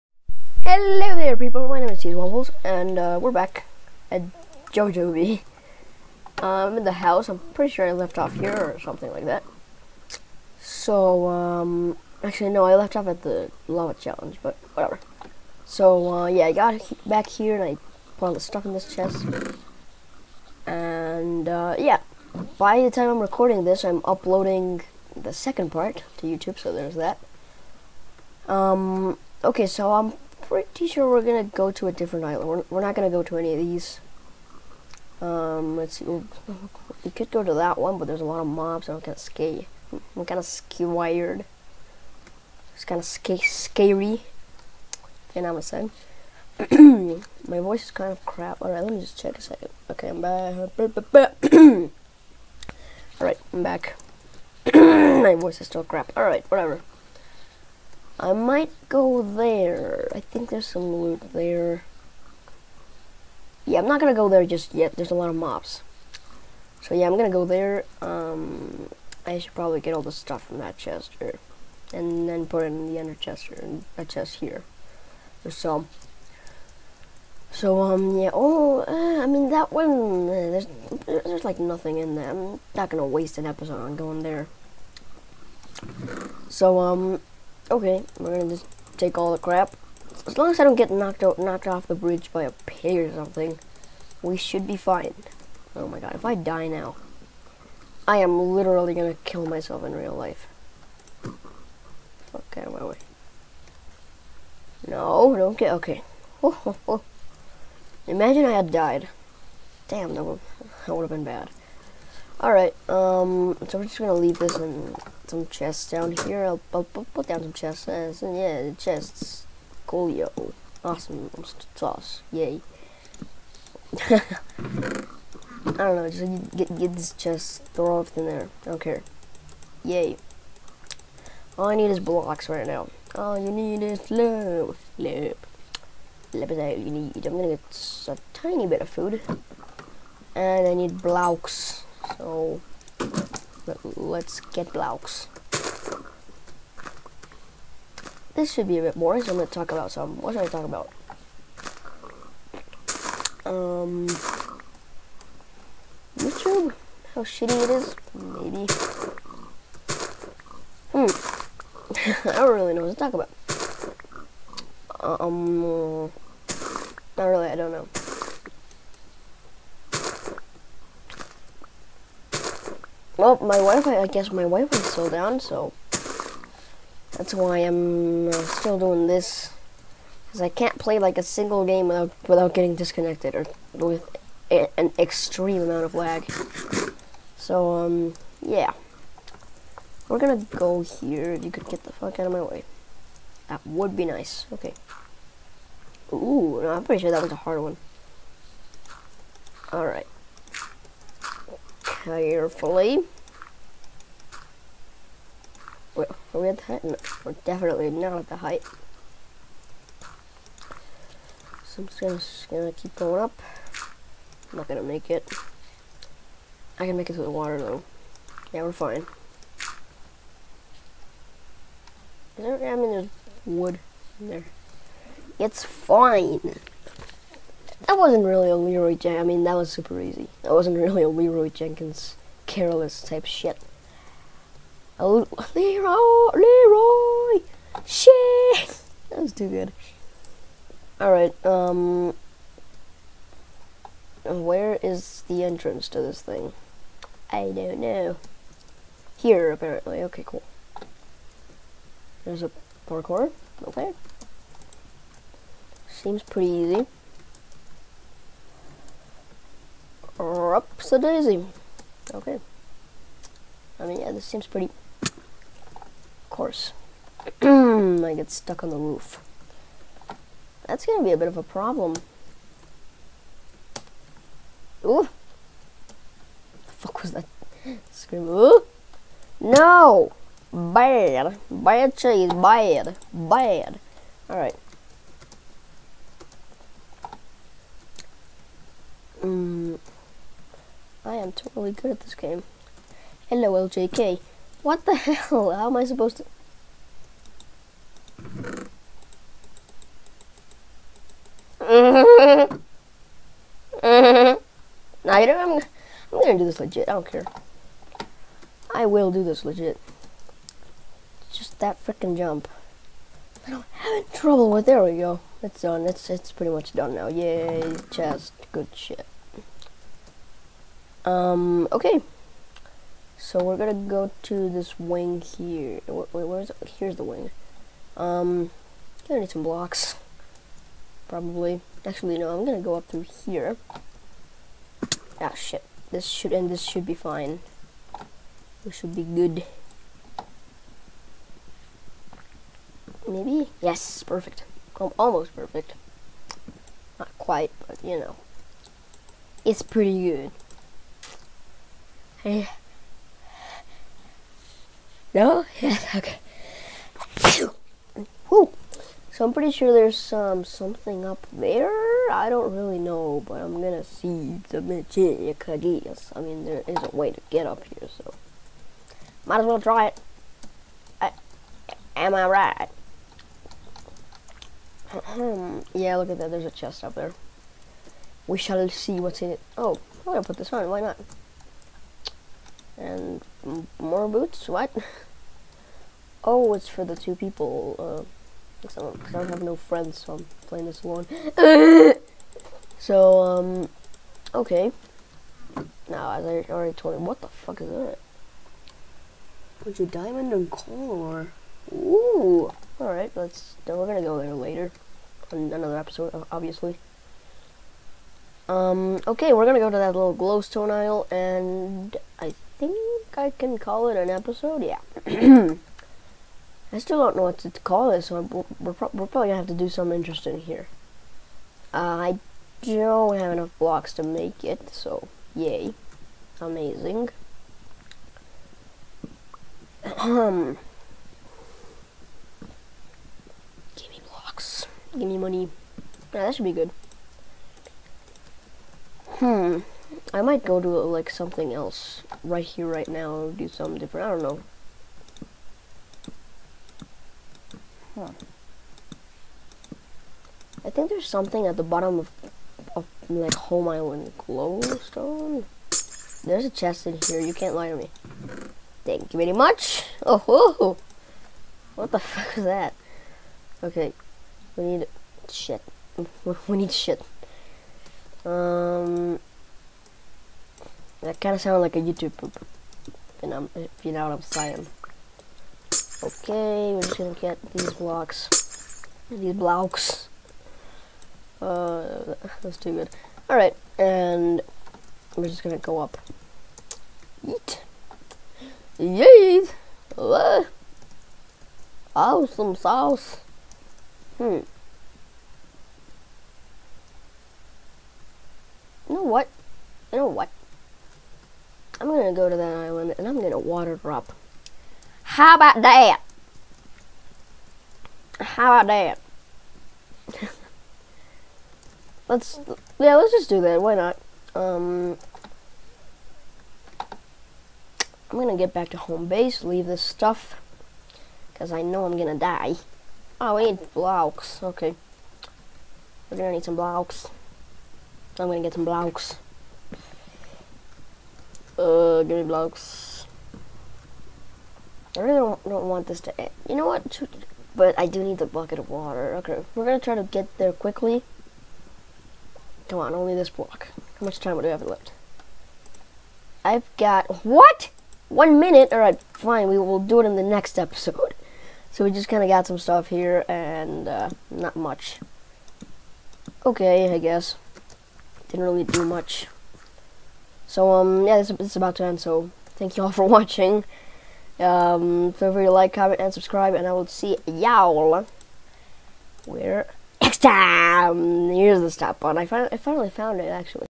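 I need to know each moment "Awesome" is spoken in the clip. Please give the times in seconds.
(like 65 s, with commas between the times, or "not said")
120 s, 491 s.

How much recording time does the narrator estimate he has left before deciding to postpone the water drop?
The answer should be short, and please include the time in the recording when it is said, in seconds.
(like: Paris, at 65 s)
1 minute, at 548 s.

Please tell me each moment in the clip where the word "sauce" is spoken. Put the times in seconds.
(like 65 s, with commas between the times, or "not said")
121 s, 492 s.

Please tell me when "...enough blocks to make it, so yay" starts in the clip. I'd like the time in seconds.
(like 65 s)
423 s.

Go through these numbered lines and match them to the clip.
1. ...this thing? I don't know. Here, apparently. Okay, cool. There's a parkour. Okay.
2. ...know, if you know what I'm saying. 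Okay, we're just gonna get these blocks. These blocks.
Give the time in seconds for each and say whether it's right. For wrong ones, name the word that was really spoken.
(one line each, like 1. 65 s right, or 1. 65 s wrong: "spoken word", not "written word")
1. 246 s right
2. 473 s right.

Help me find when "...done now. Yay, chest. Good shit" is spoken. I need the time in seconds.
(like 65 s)
316 s.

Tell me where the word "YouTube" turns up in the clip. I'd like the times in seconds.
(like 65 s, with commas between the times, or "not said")
26 s, 156 s, 471 s.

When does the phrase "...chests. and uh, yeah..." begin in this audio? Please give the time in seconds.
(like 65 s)
117 s.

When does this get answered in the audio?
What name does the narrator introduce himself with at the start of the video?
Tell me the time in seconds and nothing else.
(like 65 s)
2 s.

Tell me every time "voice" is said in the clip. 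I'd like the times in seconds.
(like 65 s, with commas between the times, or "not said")
47 s, 55 s.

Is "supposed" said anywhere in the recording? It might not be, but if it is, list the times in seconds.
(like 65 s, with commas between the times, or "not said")
295 s.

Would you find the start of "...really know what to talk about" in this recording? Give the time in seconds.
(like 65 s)
162 s.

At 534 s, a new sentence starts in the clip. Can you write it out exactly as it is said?
I really don't, don't want this to end.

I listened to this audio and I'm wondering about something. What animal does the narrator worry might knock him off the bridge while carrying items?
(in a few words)
a pig.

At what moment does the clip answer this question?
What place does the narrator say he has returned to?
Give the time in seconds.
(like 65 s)
4 s.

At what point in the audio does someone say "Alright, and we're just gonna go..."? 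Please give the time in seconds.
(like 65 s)
483 s.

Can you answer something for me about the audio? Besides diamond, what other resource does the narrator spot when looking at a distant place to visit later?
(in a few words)
coal.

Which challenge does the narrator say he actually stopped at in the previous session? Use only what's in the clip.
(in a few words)
the lava challenge.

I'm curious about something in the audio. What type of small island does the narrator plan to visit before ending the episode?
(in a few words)
glowstone isle.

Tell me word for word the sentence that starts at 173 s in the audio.
Well, my Wi-Fi, I guess my Wi-Fi is still down, so that's why I'm uh, still doing this.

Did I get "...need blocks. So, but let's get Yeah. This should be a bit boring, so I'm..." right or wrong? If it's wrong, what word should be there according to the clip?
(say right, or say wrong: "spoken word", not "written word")
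wrong: "Blaux", not "Yeah".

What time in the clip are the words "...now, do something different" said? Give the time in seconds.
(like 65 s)
442 s.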